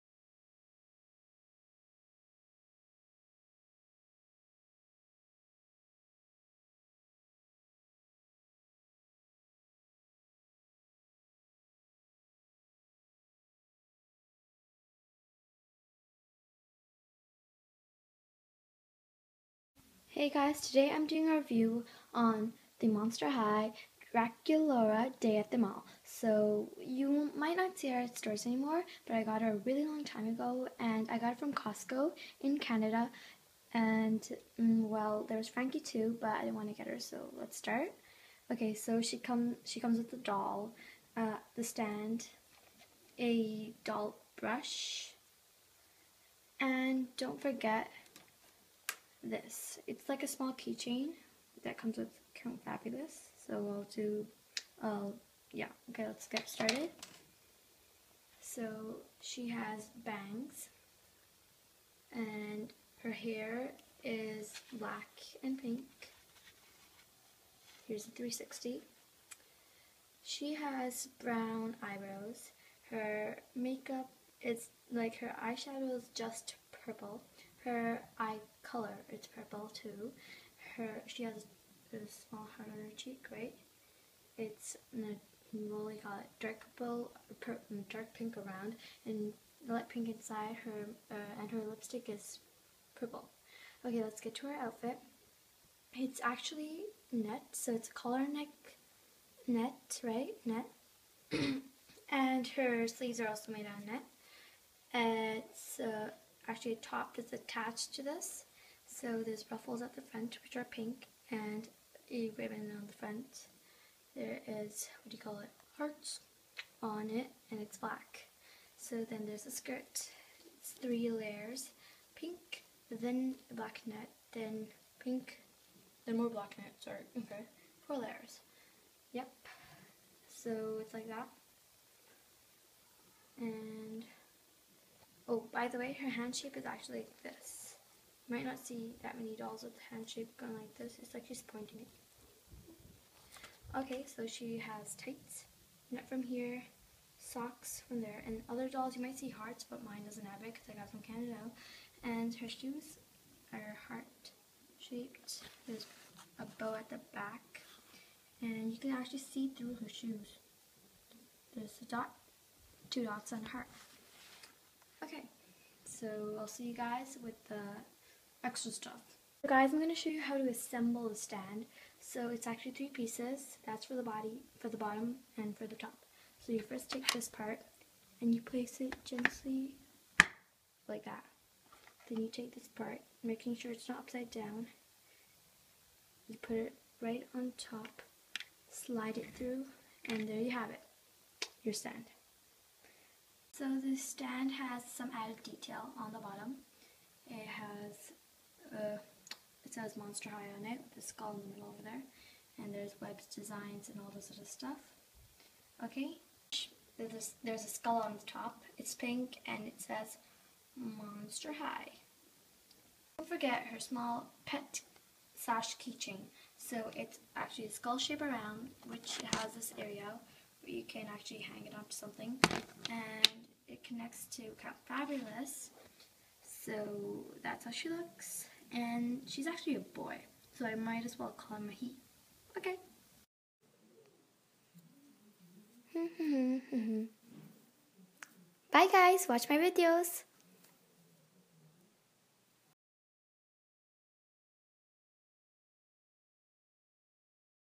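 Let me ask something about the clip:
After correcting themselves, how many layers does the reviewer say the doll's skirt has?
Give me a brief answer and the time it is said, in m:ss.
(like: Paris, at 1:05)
4, at 2:07.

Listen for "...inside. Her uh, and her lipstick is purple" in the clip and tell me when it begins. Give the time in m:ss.
1:30.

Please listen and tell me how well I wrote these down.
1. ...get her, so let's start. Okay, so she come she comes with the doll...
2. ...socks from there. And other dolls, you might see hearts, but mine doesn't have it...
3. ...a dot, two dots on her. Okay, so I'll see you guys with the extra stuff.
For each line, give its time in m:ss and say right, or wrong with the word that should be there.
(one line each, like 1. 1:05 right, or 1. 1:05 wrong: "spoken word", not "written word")
1. 0:36 right
2. 2:27 right
3. 2:41 right.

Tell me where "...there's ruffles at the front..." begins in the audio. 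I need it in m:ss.
1:49.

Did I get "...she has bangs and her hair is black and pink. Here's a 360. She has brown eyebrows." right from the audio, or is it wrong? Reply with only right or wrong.
right.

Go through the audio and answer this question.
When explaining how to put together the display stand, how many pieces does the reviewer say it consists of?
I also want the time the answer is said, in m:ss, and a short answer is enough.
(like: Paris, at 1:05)
3, at 2:52.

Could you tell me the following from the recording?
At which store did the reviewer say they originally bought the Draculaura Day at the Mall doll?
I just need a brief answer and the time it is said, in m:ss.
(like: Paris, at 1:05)
Costco, at 0:31.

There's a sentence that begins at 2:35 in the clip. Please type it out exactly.
There's a bow at the back.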